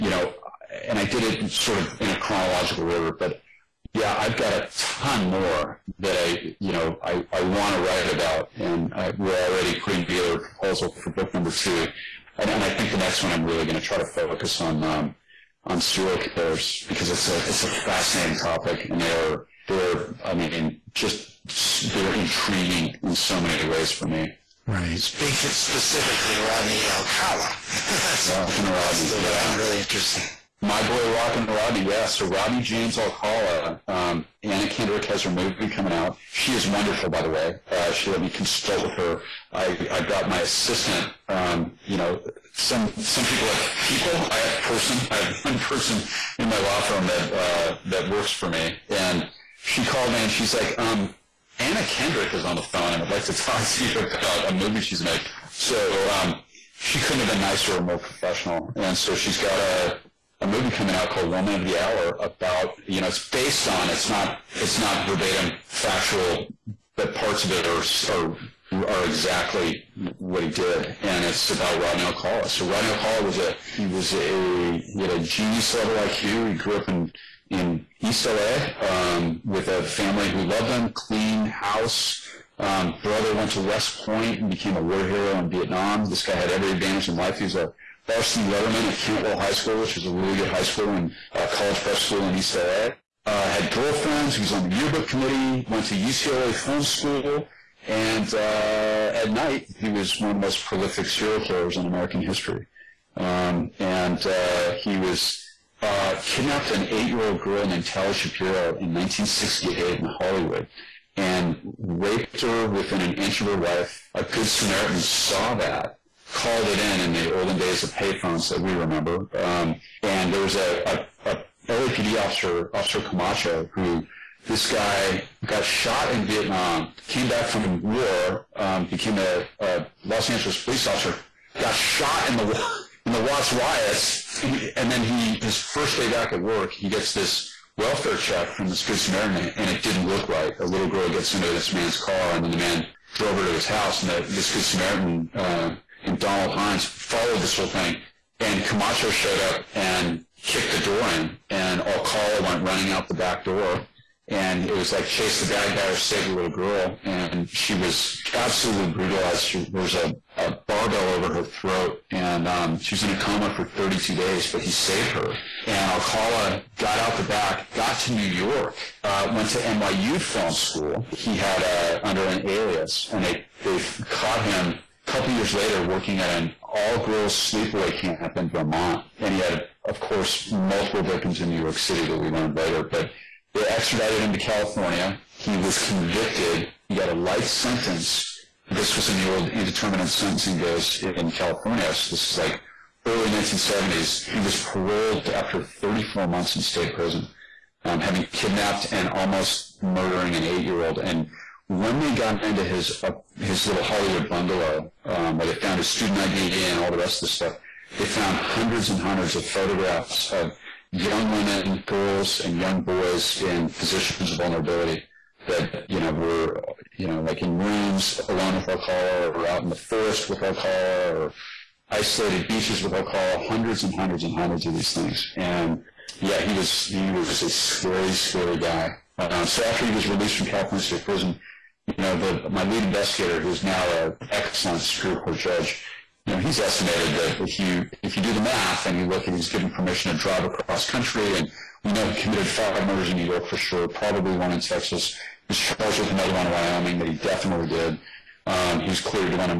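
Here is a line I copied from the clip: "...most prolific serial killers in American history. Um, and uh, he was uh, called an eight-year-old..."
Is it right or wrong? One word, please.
wrong.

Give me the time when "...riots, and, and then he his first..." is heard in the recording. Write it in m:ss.
2:13.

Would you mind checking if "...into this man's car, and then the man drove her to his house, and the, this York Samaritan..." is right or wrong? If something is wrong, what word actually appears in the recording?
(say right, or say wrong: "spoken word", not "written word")
wrong: "Good", not "York".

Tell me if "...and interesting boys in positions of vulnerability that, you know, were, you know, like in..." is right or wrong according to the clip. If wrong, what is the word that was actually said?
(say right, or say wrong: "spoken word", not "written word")
wrong: "young", not "interesting".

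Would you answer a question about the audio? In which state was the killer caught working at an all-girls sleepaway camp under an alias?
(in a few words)
Vermont.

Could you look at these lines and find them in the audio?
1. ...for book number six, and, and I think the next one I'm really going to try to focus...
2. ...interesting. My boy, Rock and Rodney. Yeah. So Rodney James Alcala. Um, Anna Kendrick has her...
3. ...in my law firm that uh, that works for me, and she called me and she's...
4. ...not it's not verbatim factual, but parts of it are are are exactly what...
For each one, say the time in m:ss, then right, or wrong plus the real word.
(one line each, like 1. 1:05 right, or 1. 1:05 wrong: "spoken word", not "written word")
1. 0:11 wrong: "two", not "six"
2. 0:29 right
3. 0:46 right
4. 1:04 right.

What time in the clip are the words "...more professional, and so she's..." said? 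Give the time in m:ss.
0:57.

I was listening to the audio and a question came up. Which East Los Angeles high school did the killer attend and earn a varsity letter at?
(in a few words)
Cantwell High School.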